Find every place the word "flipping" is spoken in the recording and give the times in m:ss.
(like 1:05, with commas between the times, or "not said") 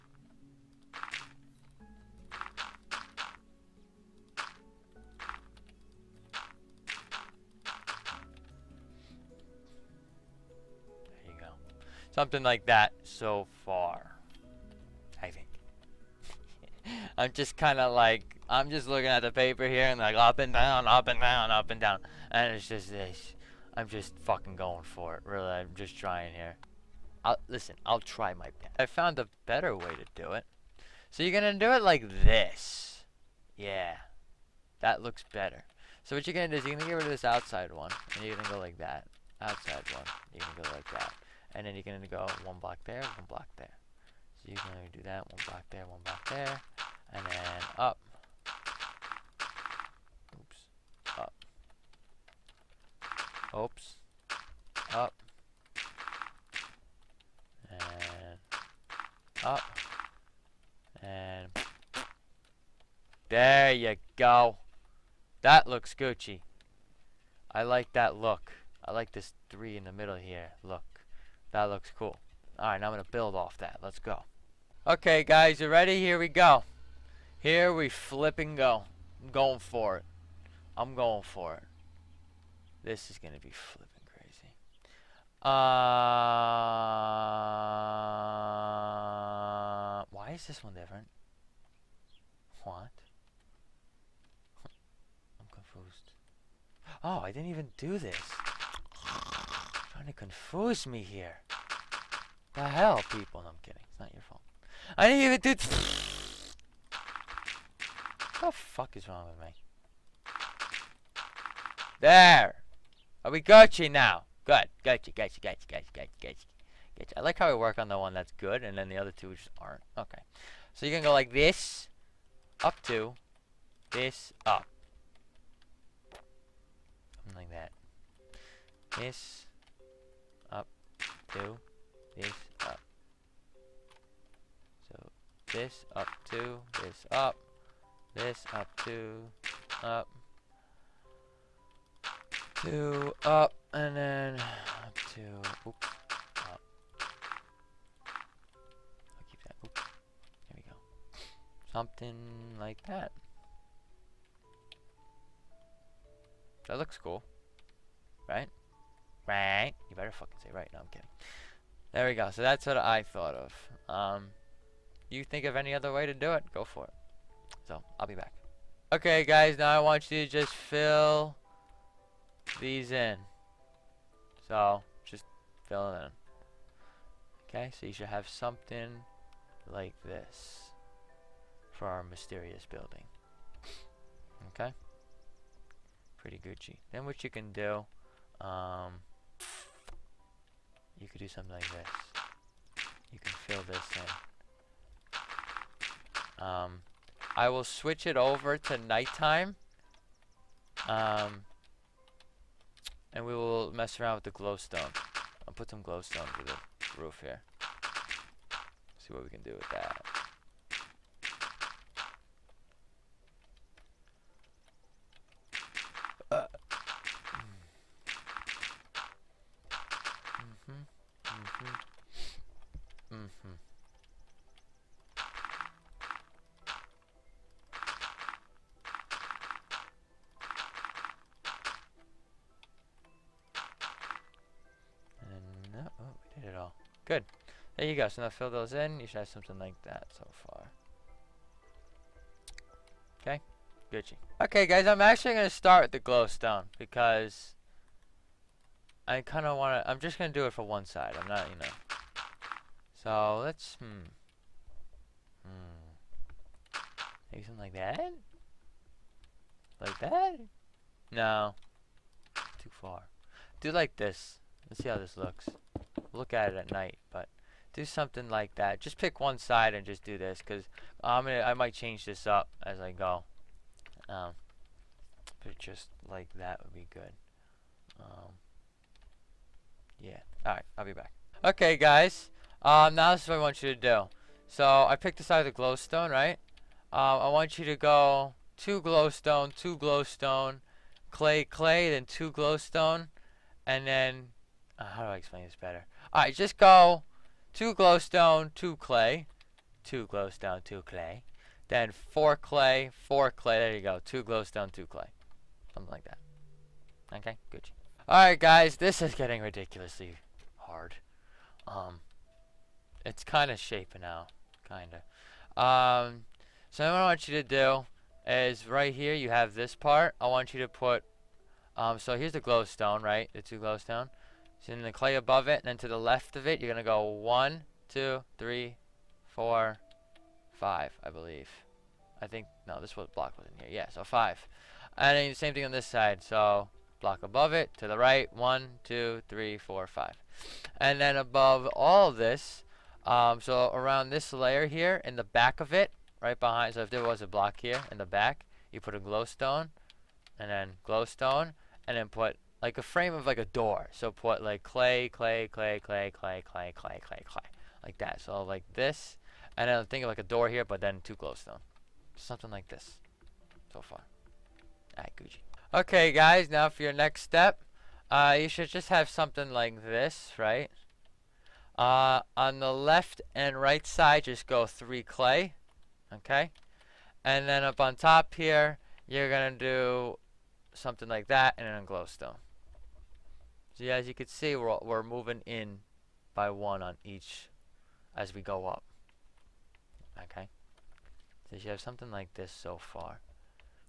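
1:17, 1:23.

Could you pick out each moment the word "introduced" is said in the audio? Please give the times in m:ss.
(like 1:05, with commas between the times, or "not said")
not said.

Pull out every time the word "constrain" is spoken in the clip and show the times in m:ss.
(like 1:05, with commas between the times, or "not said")
not said.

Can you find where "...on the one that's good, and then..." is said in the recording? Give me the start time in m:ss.
1:57.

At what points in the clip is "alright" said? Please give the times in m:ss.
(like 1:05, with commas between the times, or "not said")
1:12, 5:08, 6:04.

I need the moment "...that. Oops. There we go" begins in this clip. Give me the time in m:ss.
2:29.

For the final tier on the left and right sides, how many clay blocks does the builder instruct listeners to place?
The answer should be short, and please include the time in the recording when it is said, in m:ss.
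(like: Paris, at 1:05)
3, at 6:14.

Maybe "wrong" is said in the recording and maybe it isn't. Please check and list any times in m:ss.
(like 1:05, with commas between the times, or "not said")
1:49.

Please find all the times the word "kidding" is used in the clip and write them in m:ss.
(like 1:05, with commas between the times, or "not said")
1:43, 2:40.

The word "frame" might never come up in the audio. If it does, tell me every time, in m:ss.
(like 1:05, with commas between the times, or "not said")
5:52.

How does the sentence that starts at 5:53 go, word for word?
So put like clay, clay, clay, clay, clay, clay, clay, clay, clay, like that.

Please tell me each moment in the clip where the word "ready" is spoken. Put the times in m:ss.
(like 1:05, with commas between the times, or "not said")
1:15.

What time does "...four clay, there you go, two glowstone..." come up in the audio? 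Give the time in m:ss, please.
5:02.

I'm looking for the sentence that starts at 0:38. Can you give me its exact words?
And you're going to go like that.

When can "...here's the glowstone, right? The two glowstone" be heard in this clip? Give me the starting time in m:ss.
5:22.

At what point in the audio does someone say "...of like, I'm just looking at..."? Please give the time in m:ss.
0:17.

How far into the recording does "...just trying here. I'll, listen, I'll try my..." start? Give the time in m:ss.
0:25.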